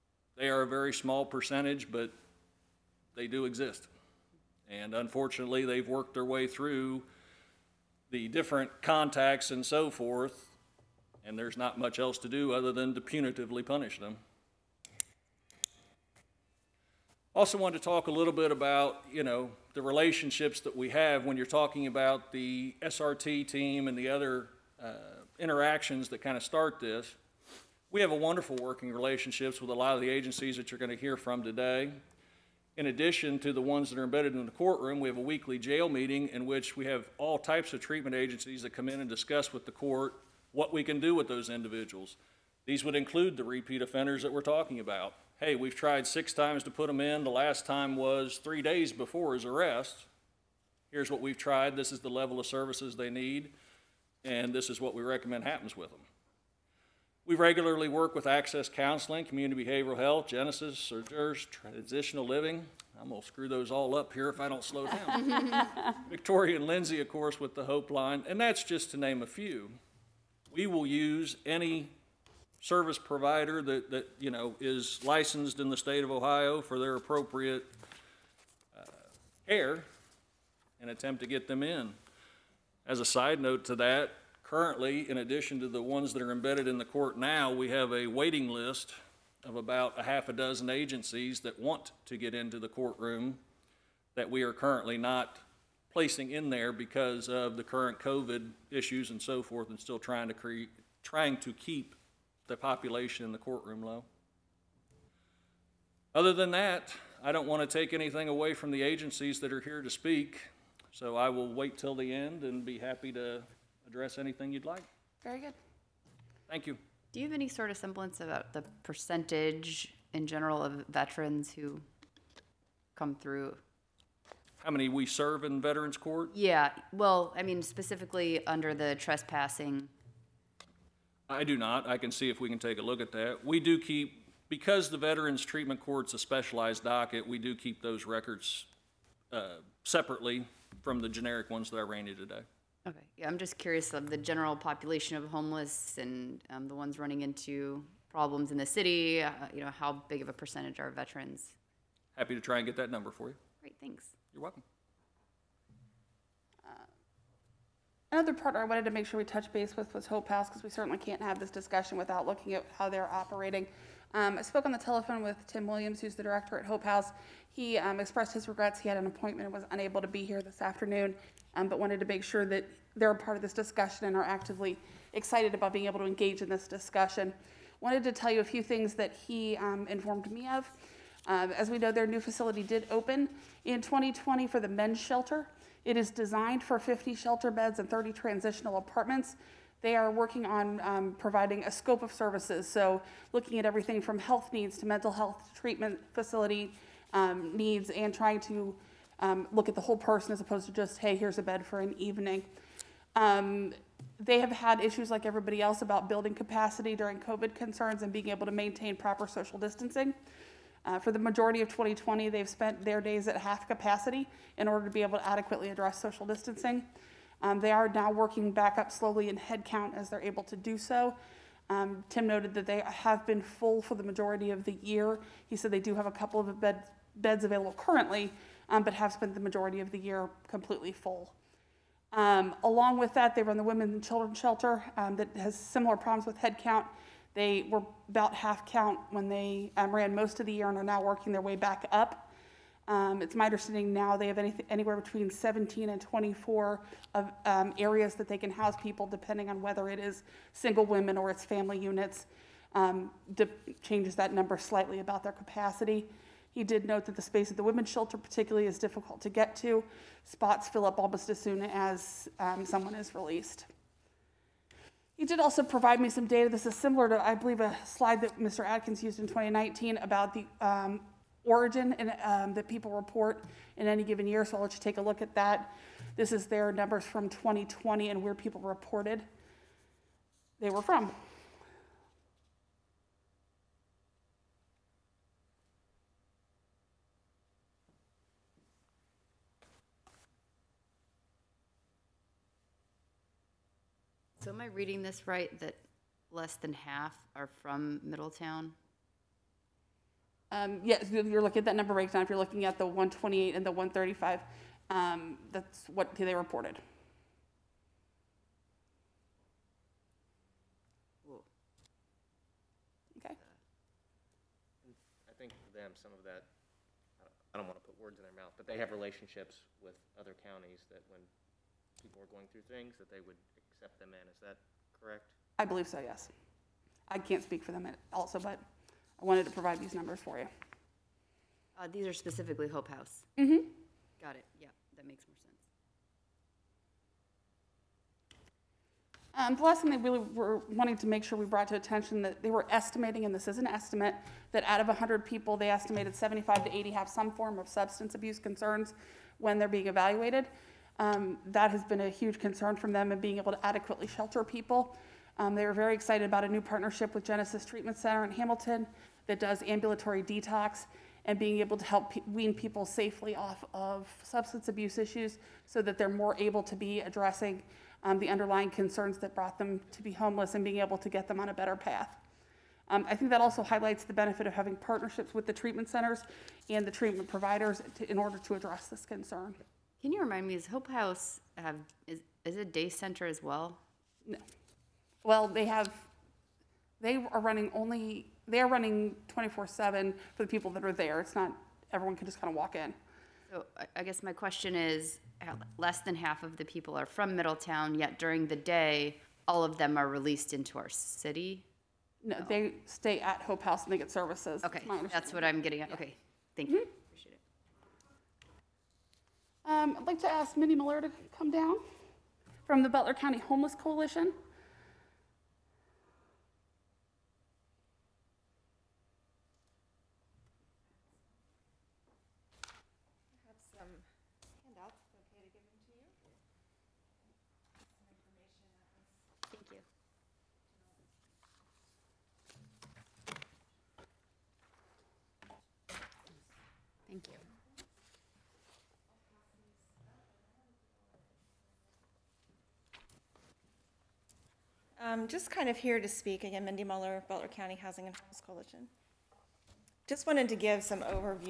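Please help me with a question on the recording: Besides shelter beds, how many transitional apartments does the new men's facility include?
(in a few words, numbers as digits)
30.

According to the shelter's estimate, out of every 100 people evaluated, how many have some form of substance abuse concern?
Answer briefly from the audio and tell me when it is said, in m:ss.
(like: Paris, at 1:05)
75 to 80, at 5:46.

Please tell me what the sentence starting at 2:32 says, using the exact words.
Happy to try and get that number for you.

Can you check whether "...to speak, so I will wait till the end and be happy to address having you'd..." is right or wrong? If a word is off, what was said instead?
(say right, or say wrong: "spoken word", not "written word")
wrong: "anything", not "having".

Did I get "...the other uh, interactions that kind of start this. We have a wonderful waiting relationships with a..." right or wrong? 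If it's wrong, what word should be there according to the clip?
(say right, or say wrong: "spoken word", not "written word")
wrong: "working", not "waiting".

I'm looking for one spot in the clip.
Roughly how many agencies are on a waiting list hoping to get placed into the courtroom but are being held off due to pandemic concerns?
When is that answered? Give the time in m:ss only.
1:30.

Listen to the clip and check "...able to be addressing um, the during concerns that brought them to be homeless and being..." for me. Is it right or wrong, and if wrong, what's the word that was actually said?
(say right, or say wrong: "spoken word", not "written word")
wrong: "underlying", not "during".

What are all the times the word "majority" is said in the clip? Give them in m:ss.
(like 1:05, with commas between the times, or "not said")
3:31, 3:44, 3:49.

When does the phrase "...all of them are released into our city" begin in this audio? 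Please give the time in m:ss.
6:39.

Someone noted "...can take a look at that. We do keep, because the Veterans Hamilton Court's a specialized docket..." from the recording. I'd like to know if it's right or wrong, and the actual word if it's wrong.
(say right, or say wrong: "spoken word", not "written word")
wrong: "Treatment", not "Hamilton".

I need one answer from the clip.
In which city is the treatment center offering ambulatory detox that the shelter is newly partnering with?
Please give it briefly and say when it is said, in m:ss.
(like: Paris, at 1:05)
Hamilton, at 5:58.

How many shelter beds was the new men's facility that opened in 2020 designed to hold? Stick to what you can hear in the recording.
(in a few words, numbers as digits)
50.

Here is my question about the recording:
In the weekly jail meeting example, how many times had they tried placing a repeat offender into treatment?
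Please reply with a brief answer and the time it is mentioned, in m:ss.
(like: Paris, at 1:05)
6, at 0:46.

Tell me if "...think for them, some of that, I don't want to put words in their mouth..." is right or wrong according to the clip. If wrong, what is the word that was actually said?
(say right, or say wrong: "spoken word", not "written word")
right.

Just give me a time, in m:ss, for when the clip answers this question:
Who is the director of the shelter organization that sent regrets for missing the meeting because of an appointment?
2:45.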